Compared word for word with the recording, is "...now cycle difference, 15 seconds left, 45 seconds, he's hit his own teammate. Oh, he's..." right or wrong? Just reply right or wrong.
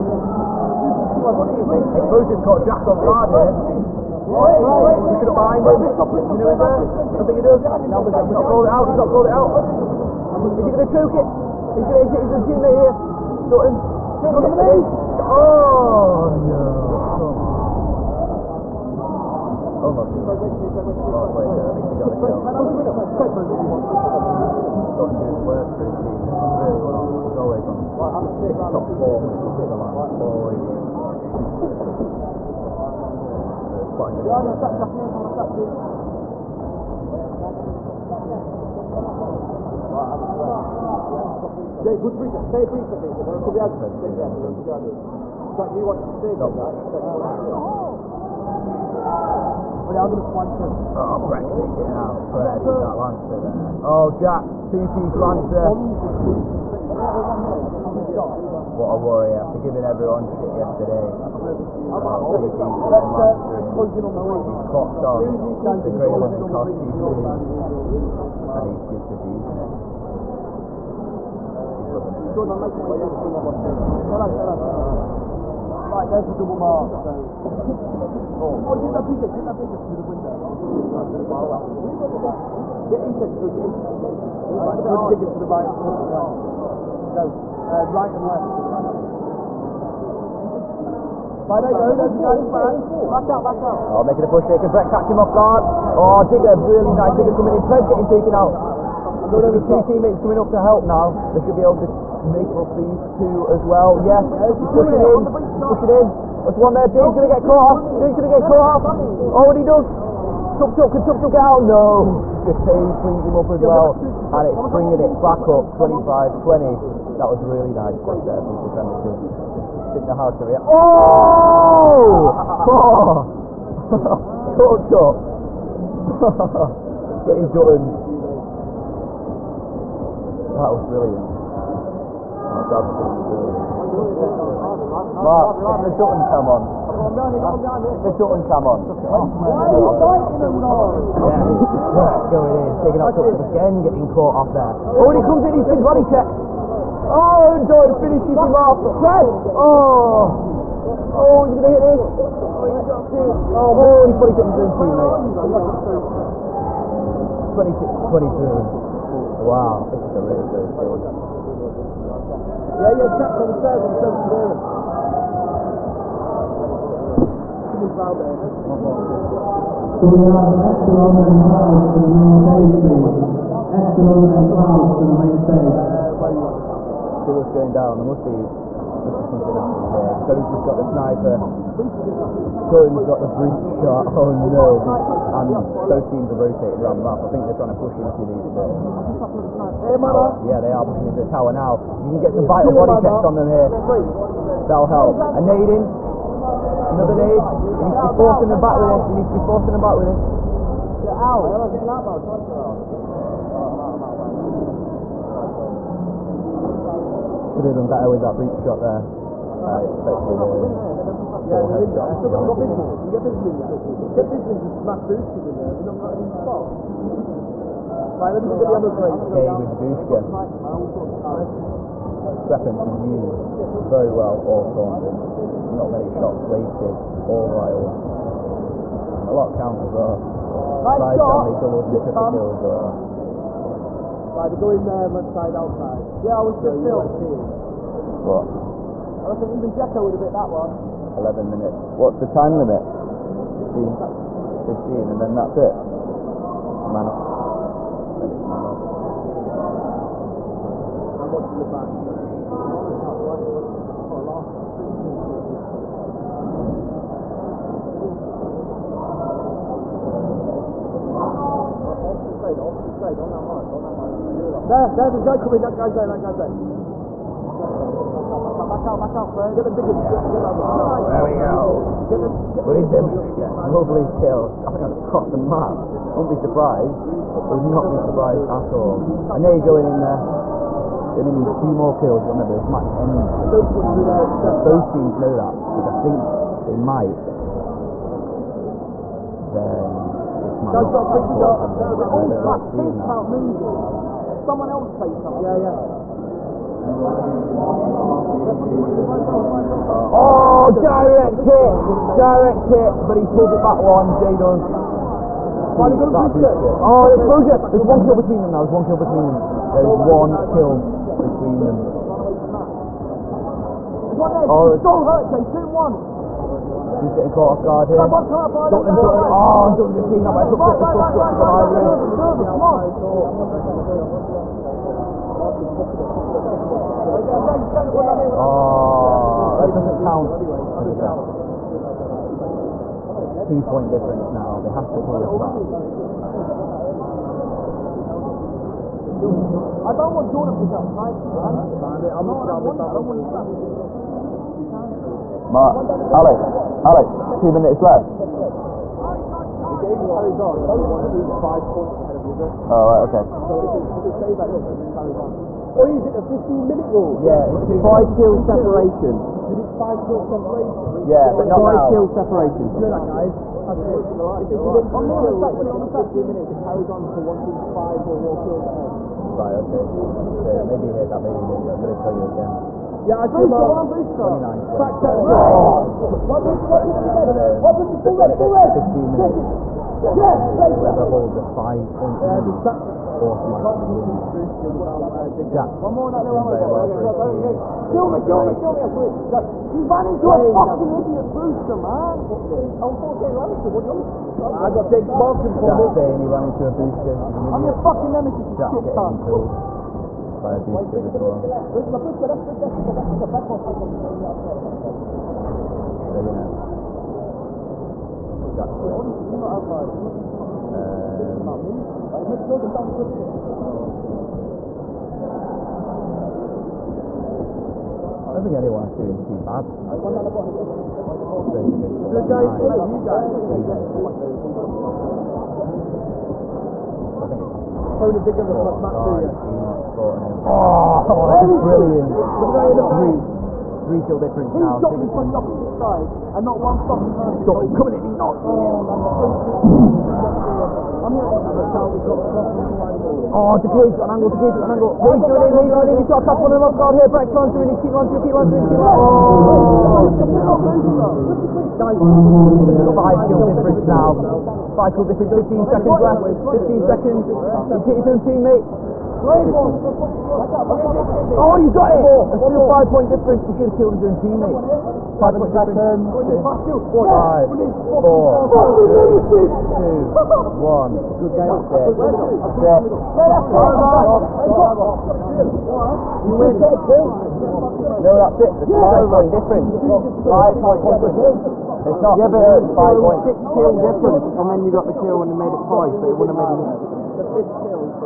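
wrong.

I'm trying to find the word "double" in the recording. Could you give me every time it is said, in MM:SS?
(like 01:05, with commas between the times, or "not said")
01:16, 03:51.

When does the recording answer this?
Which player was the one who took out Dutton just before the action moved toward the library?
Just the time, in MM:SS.
05:20.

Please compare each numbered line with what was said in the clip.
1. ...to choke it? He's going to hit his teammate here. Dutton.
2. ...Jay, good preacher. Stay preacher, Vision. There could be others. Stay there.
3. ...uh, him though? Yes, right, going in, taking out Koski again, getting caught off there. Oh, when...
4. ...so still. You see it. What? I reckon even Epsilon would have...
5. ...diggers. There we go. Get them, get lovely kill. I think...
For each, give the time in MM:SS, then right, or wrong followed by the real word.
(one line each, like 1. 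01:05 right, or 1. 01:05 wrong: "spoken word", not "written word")
1. 00:10 right
2. 00:41 wrong: "Jay", not "Vision"
3. 02:20 wrong: "Tuxup", not "Koski"
4. 03:56 wrong: "Jekko", not "Epsilon"
5. 04:29 right.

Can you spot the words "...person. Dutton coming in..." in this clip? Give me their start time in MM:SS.
07:17.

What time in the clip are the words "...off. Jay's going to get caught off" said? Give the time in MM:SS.
01:47.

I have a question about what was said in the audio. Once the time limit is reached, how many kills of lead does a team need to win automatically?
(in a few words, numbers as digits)
5.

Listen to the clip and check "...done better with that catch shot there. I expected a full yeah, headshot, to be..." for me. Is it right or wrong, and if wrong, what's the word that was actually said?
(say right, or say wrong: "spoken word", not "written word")
wrong: "breach", not "catch".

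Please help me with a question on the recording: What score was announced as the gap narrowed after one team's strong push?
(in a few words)
25 20.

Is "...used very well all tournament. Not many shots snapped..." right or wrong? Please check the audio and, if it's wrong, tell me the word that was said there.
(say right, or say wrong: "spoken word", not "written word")
wrong: "wasted", not "snapped".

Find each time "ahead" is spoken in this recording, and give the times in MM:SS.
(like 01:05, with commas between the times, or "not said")
05:51, 06:08.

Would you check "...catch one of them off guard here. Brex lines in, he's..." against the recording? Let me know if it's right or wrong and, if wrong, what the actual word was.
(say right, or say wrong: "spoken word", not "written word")
right.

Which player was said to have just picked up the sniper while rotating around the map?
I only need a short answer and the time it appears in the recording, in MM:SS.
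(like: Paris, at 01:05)
Expo, at 03:00.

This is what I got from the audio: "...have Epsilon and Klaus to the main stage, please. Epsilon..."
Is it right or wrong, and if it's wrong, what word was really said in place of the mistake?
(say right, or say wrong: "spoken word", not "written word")
right.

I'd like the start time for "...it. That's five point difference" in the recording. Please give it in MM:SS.
07:58.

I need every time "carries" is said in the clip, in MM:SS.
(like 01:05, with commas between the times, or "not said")
05:50, 05:54, 06:06.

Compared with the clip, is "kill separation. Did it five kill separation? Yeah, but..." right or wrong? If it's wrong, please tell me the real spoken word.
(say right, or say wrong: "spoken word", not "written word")
right.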